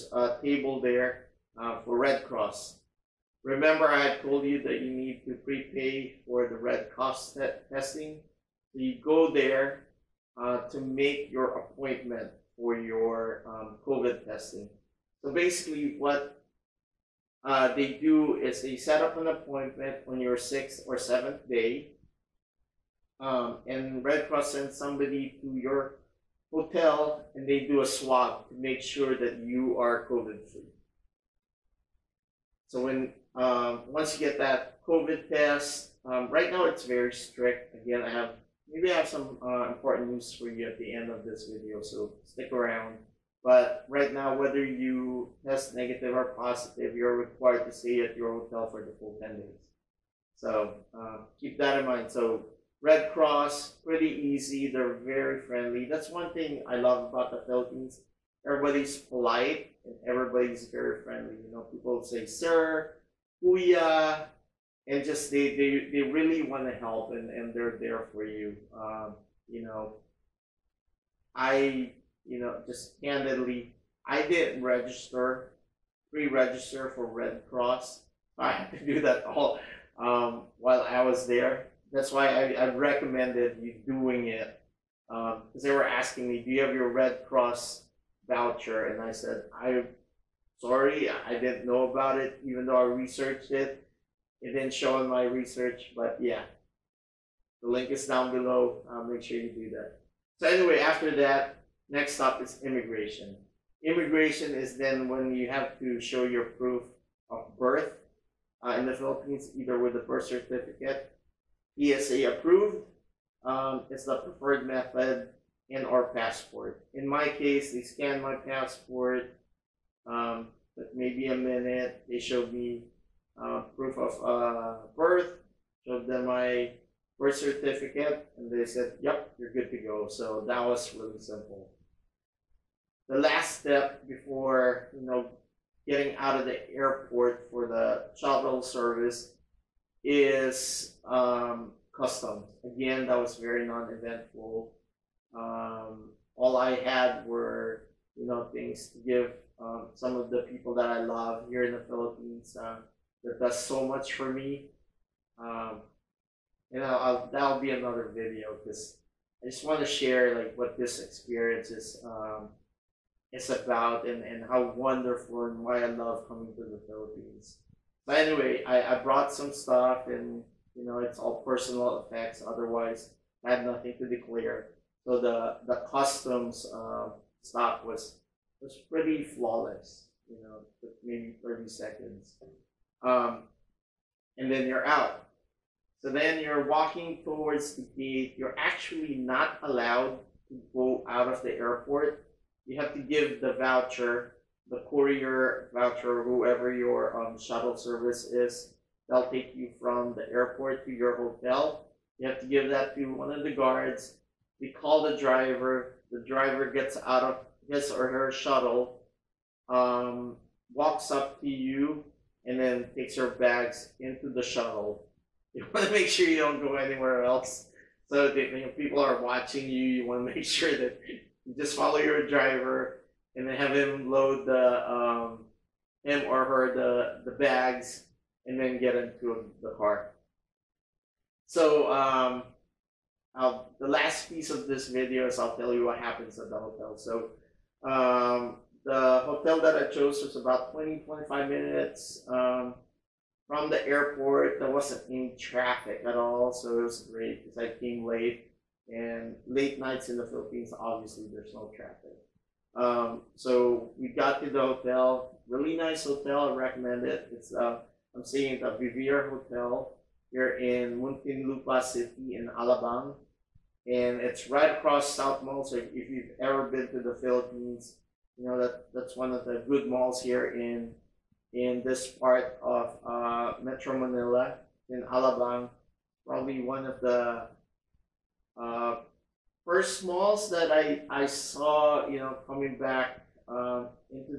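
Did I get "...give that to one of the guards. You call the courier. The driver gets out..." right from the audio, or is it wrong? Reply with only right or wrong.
wrong.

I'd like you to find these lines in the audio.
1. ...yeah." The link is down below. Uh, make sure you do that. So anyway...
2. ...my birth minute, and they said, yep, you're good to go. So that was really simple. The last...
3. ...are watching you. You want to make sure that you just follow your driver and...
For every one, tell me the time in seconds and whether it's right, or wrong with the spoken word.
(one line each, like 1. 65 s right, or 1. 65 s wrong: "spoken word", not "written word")
1. 96 s right
2. 126 s wrong: "certificate", not "minute"
3. 219 s right.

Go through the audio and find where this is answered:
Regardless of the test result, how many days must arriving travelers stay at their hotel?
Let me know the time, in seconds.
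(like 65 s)
49 s.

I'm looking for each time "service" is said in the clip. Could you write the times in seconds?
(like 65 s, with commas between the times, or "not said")
138 s, 197 s.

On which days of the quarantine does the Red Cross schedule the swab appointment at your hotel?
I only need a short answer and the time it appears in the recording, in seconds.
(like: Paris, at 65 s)
6th or 7th day, at 20 s.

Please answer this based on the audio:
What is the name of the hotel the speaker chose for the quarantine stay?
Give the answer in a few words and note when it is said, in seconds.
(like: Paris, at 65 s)
Vivere Hotel, at 258 s.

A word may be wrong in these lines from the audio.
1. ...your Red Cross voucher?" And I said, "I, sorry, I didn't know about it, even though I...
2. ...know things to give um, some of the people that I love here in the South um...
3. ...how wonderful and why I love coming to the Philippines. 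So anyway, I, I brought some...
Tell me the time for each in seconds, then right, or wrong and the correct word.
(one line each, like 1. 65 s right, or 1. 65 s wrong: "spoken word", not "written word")
1. 86 s right
2. 148 s wrong: "Philippines", not "South"
3. 164 s right.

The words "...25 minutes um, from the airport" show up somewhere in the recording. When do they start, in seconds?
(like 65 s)
241 s.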